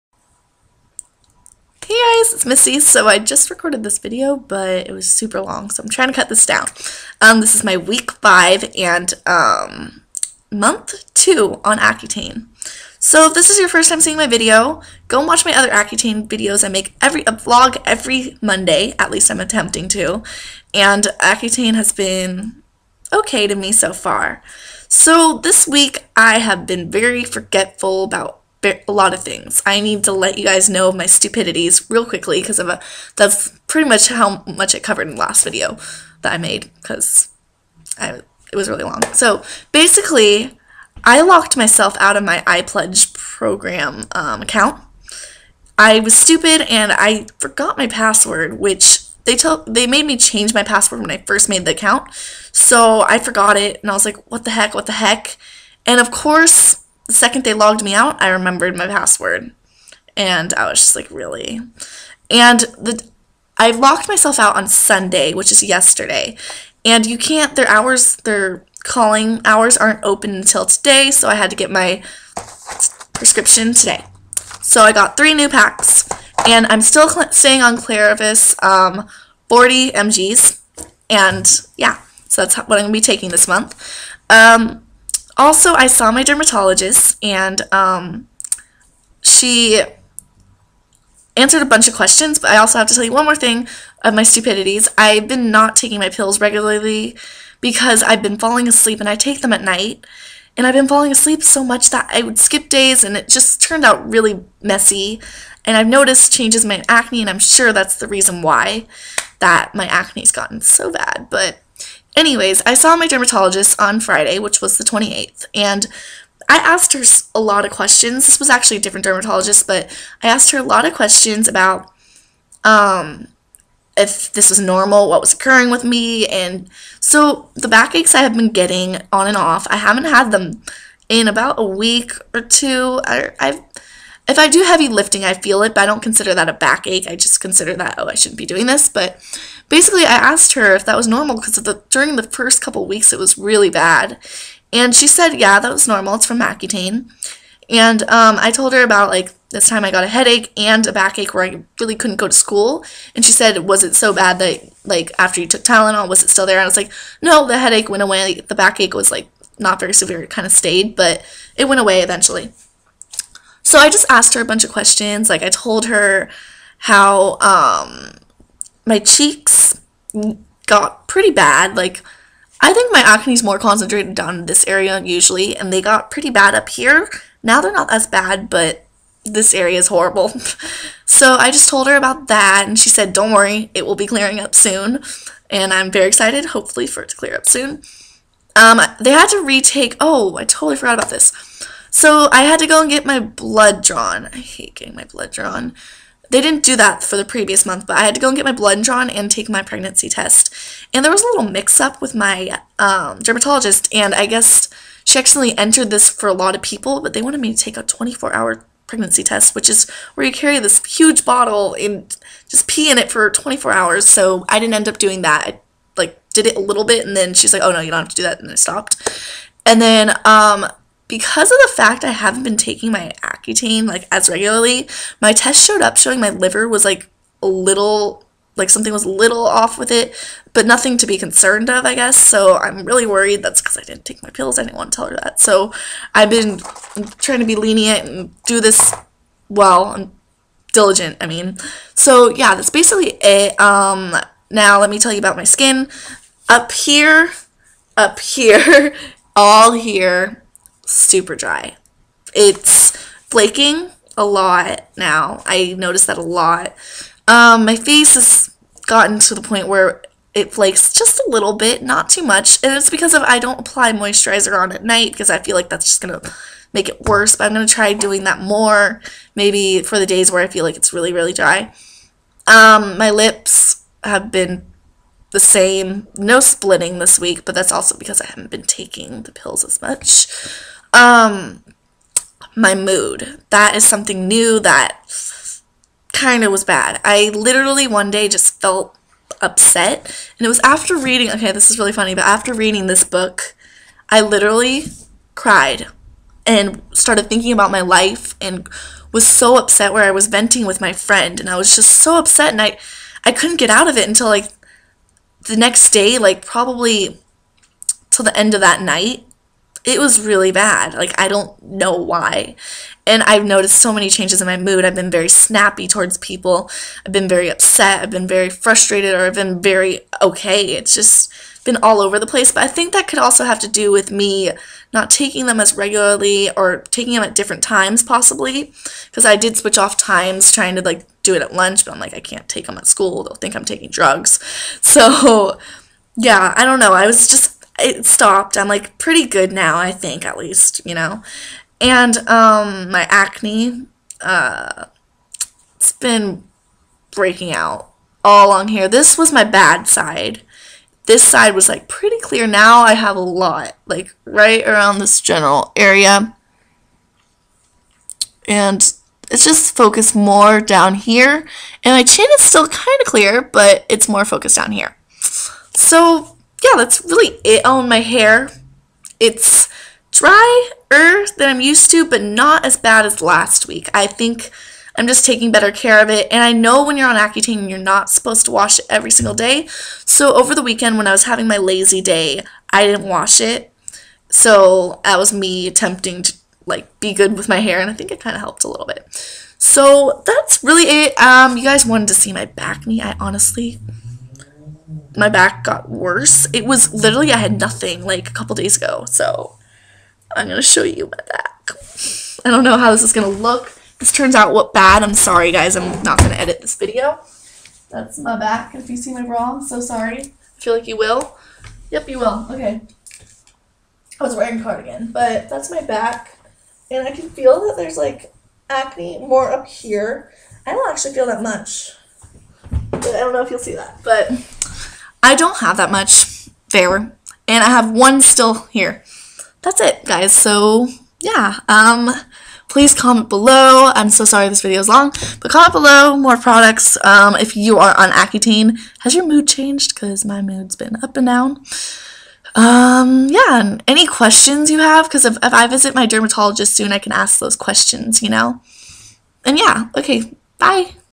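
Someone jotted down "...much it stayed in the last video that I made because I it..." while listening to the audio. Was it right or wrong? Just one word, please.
wrong.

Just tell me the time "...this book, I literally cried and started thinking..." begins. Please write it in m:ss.
4:52.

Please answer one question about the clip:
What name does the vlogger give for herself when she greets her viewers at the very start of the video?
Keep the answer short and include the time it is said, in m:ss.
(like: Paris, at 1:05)
Missy, at 0:02.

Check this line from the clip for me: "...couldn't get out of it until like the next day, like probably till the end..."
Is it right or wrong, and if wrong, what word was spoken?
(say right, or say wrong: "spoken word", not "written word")
right.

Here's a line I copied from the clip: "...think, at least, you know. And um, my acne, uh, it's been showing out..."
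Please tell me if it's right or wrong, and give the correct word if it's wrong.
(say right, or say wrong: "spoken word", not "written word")
wrong: "breaking", not "showing".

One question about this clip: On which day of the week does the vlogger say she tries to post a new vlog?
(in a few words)
Monday.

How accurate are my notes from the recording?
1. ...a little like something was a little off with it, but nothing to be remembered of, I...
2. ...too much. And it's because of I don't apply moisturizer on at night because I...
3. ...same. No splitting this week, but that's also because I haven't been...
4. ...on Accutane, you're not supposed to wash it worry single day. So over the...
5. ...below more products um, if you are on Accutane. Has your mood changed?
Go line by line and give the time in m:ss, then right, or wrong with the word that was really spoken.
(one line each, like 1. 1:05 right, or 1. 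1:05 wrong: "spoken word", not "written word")
1. 3:47 wrong: "concerned", not "remembered"
2. 4:22 right
3. 4:35 right
4. 6:17 wrong: "every", not "worry"
5. 7:15 right.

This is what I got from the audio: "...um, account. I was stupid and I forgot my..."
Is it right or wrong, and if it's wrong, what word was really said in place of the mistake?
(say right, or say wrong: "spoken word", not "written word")
right.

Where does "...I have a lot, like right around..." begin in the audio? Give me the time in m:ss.
5:52.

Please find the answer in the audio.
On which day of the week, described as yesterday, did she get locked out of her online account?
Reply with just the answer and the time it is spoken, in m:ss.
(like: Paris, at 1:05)
Sunday, at 1:04.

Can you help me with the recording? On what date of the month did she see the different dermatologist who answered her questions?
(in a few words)
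28th.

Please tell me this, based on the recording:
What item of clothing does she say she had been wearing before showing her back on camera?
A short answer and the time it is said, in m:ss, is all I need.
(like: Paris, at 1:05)
Cardigan, at 6:54.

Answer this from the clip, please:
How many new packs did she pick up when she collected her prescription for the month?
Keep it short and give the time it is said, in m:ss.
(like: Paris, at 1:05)
3, at 1:15.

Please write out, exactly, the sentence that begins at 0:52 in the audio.
So I forgot it and I was like, what the heck, what the heck?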